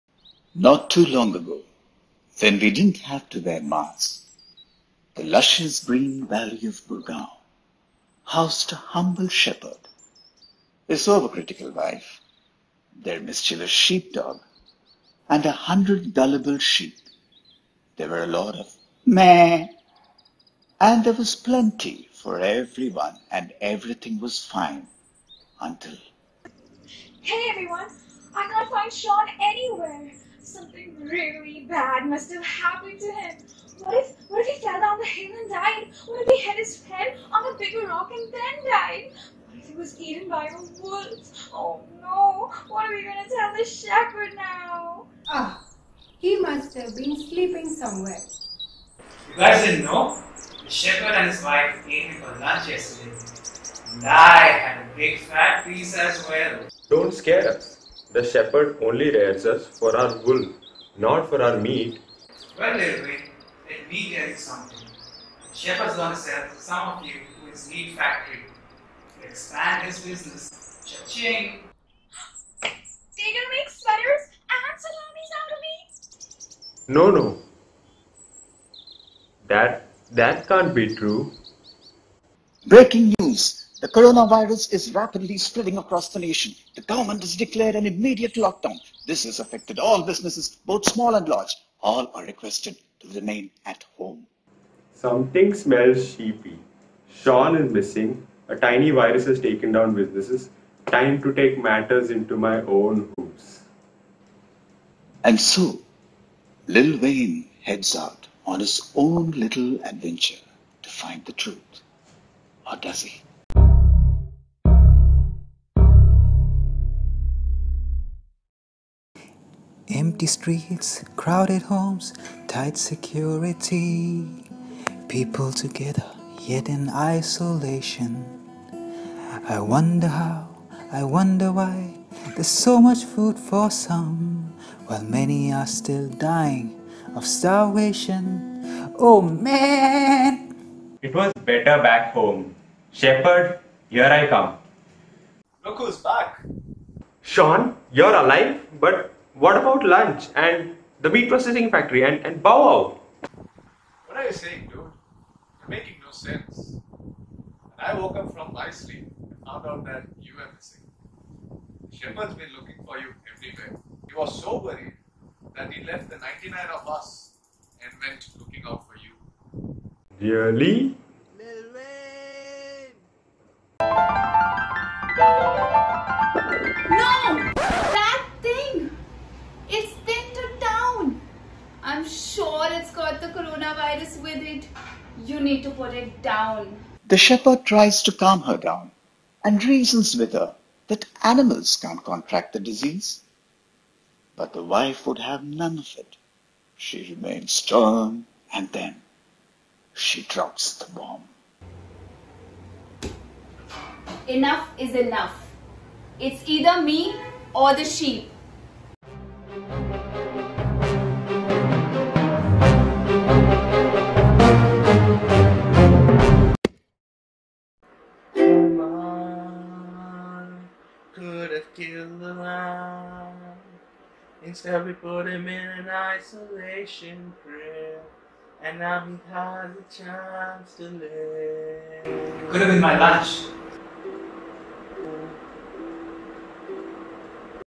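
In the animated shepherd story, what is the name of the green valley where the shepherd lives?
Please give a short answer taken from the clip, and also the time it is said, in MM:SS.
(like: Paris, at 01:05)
Gurgaon, at 00:06.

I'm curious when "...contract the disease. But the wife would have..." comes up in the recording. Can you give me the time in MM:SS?
03:12.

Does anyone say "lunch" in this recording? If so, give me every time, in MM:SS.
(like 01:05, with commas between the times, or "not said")
00:52, 02:29, 03:52.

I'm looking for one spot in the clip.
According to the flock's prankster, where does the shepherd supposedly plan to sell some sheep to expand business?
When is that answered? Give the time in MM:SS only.
01:07.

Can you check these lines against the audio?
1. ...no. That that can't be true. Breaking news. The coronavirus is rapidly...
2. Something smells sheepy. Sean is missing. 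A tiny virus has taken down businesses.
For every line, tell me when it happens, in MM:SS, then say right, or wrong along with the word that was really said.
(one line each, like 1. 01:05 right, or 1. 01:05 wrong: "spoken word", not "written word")
1. 01:17 right
2. 01:34 right.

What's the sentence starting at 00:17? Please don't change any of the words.
There were a lot of meh, and there was plenty for everyone, and everything was fine until.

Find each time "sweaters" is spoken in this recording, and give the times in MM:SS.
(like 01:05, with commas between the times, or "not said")
01:13.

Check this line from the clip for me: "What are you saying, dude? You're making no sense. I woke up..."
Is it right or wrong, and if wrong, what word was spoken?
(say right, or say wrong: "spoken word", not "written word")
right.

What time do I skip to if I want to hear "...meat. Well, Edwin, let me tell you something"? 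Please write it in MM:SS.
01:01.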